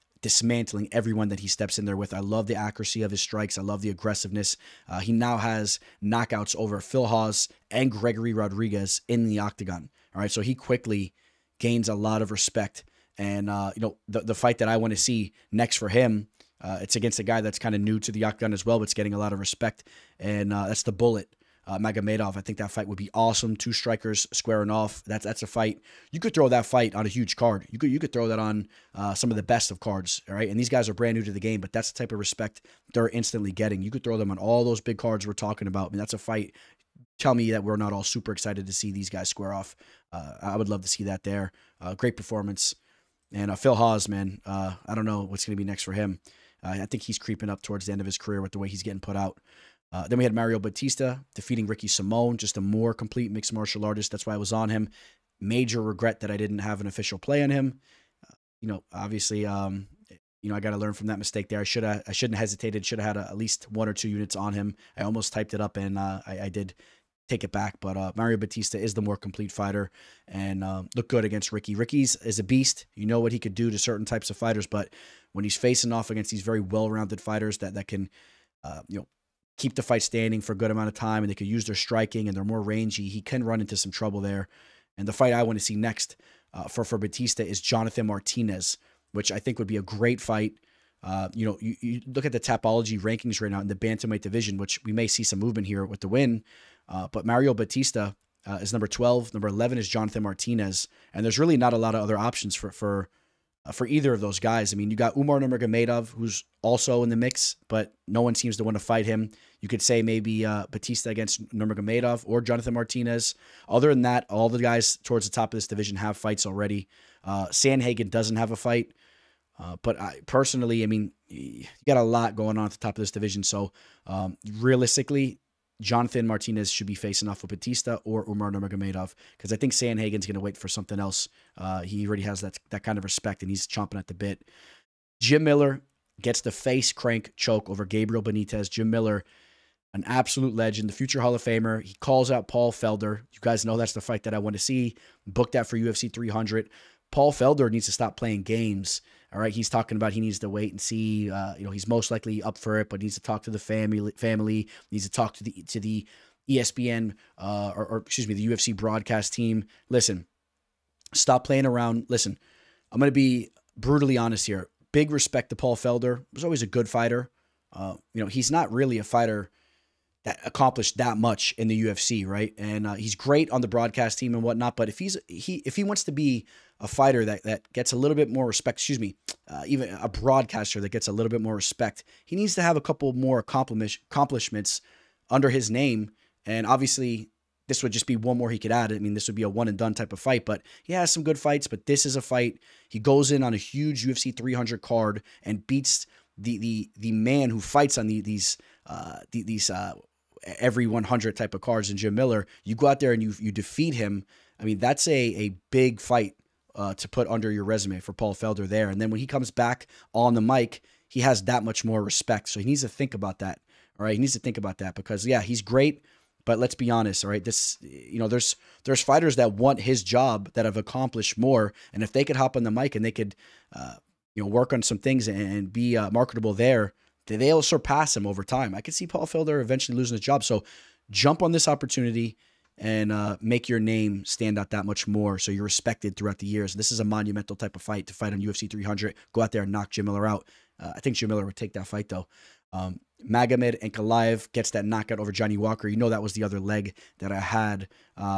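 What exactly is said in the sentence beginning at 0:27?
You could you could throw that on uh, some of the best of cards.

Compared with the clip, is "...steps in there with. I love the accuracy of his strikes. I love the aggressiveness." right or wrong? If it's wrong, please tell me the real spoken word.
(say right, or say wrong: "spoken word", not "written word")
right.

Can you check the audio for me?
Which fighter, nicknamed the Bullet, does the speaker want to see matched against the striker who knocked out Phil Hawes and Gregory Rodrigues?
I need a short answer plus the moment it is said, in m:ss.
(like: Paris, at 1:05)
Magomedov, at 0:21.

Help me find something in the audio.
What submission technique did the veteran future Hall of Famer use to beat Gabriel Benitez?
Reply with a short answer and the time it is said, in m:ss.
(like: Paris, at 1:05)
face crank choke, at 2:16.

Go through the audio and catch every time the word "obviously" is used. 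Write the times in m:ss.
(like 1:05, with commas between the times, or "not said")
0:58, 3:06.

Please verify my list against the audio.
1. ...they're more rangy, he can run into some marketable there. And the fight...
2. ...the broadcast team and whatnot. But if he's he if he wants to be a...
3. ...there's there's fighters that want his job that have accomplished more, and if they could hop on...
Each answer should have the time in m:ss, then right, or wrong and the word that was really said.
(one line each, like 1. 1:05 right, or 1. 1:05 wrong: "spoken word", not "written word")
1. 1:22 wrong: "trouble", not "marketable"
2. 2:53 right
3. 3:38 right.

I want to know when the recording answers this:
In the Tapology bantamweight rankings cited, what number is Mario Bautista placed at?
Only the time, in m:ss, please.
1:38.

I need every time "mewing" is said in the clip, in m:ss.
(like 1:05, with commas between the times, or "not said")
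not said.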